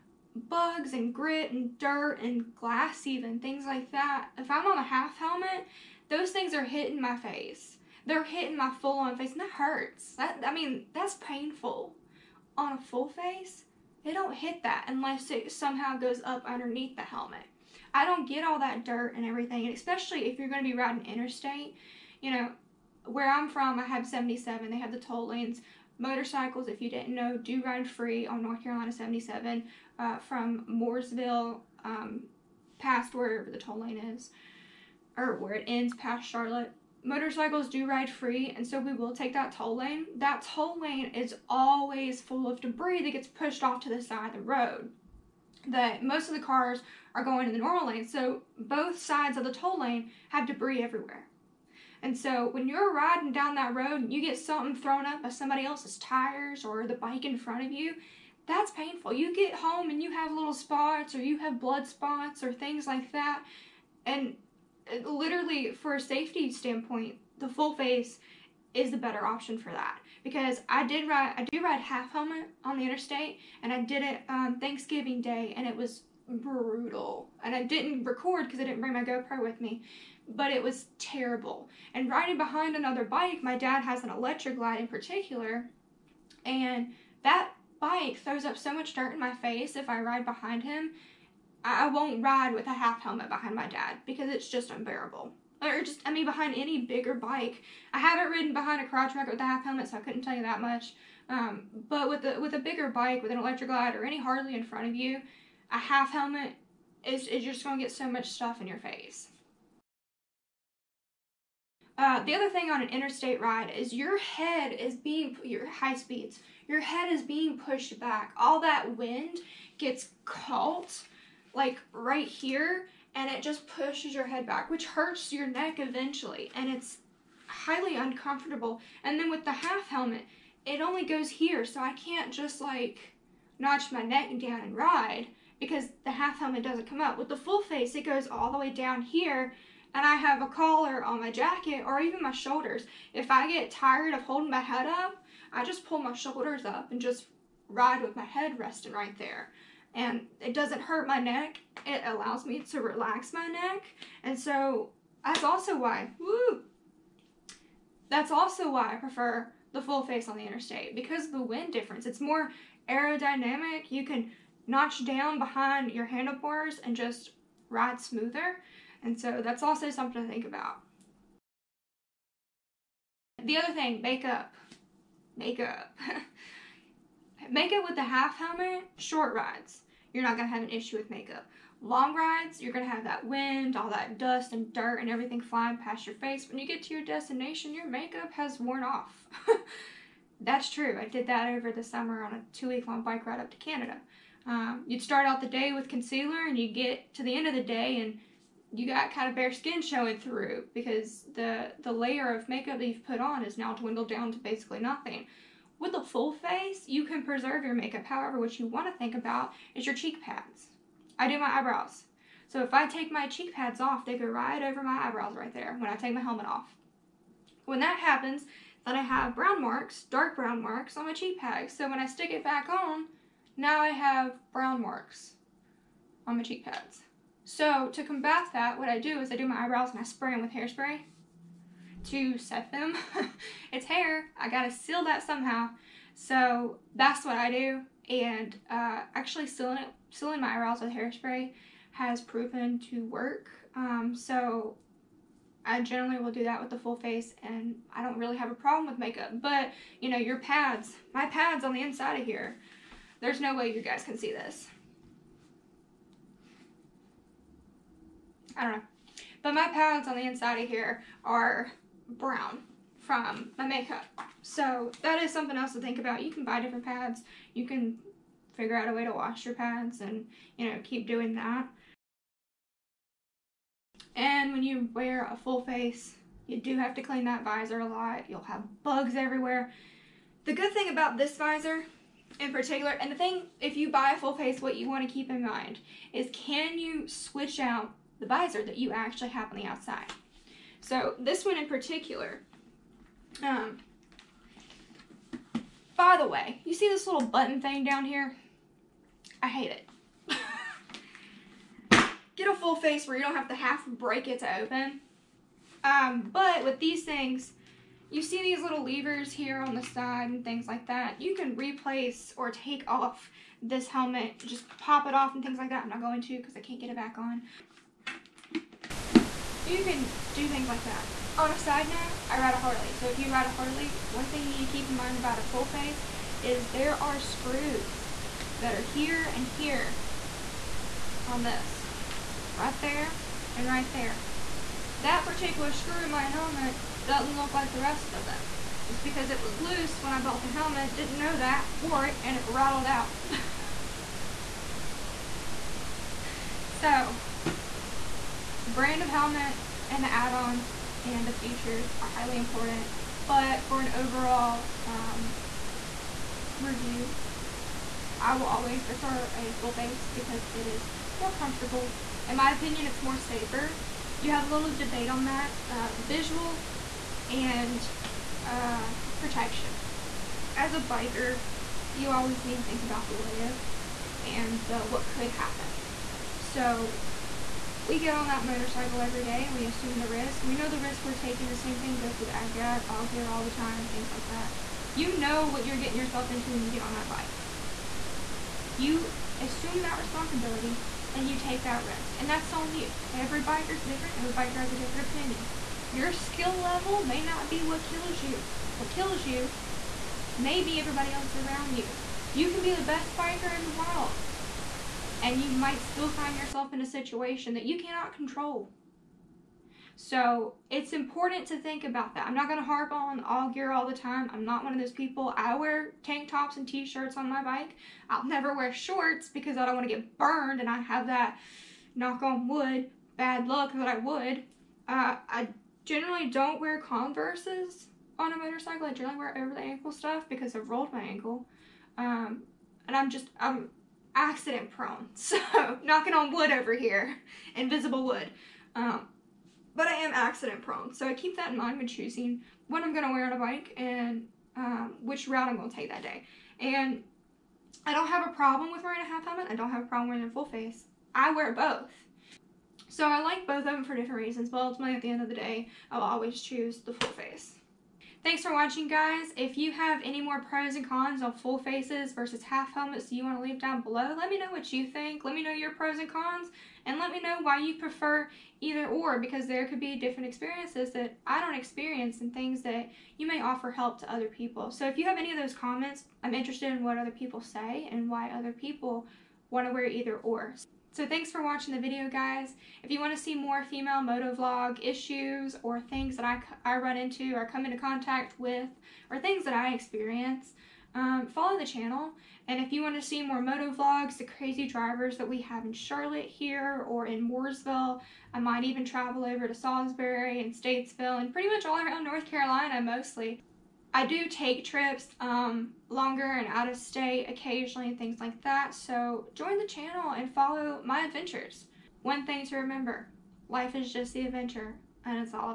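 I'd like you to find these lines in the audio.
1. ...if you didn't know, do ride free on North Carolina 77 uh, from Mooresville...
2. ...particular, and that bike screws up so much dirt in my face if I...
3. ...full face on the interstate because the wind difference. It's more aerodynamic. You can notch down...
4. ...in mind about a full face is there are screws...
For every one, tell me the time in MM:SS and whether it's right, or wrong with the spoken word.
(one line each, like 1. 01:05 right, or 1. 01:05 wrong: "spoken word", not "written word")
1. 00:26 right
2. 01:24 wrong: "throws", not "screws"
3. 02:39 right
4. 05:24 right.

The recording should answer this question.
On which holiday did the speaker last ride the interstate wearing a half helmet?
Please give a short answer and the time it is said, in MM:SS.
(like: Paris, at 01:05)
Thanksgiving Day, at 01:14.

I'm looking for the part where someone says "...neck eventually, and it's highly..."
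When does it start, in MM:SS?
02:05.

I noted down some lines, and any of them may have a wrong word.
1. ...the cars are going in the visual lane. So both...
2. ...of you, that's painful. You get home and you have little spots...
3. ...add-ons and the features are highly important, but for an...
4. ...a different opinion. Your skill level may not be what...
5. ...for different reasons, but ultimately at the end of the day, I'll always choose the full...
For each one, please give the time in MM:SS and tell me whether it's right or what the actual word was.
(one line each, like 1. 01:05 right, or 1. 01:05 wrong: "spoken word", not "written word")
1. 00:46 wrong: "normal", not "visual"
2. 00:57 right
3. 05:50 right
4. 06:34 right
5. 07:33 right.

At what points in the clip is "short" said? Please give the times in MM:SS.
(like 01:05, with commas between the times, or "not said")
02:58, 06:58.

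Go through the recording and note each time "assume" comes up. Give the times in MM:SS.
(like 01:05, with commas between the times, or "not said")
06:19, 06:29.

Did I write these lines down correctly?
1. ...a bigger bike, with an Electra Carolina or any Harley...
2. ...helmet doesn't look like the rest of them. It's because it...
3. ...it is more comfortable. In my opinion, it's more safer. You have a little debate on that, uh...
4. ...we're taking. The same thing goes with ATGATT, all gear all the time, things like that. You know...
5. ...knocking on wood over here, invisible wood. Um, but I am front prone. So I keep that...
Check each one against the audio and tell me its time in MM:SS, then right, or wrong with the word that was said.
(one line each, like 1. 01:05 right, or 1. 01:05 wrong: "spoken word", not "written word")
1. 01:42 wrong: "Glide", not "Carolina"
2. 05:36 right
3. 06:00 right
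4. 06:21 right
5. 07:15 wrong: "accident", not "front".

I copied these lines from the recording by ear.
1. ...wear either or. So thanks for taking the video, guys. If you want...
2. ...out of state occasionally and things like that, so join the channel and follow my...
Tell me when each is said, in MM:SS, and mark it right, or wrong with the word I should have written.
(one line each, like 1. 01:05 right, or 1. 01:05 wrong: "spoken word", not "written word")
1. 07:59 wrong: "watching", not "taking"
2. 08:26 right.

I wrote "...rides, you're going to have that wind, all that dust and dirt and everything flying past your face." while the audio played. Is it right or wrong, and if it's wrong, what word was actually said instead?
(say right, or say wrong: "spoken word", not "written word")
right.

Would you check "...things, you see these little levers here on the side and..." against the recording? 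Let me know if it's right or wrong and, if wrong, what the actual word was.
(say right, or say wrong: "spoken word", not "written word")
right.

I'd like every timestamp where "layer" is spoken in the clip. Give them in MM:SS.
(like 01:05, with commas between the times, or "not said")
03:21.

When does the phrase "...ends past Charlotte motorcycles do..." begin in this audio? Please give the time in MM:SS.
00:35.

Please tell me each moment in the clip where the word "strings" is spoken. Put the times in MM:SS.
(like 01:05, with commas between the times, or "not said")
not said.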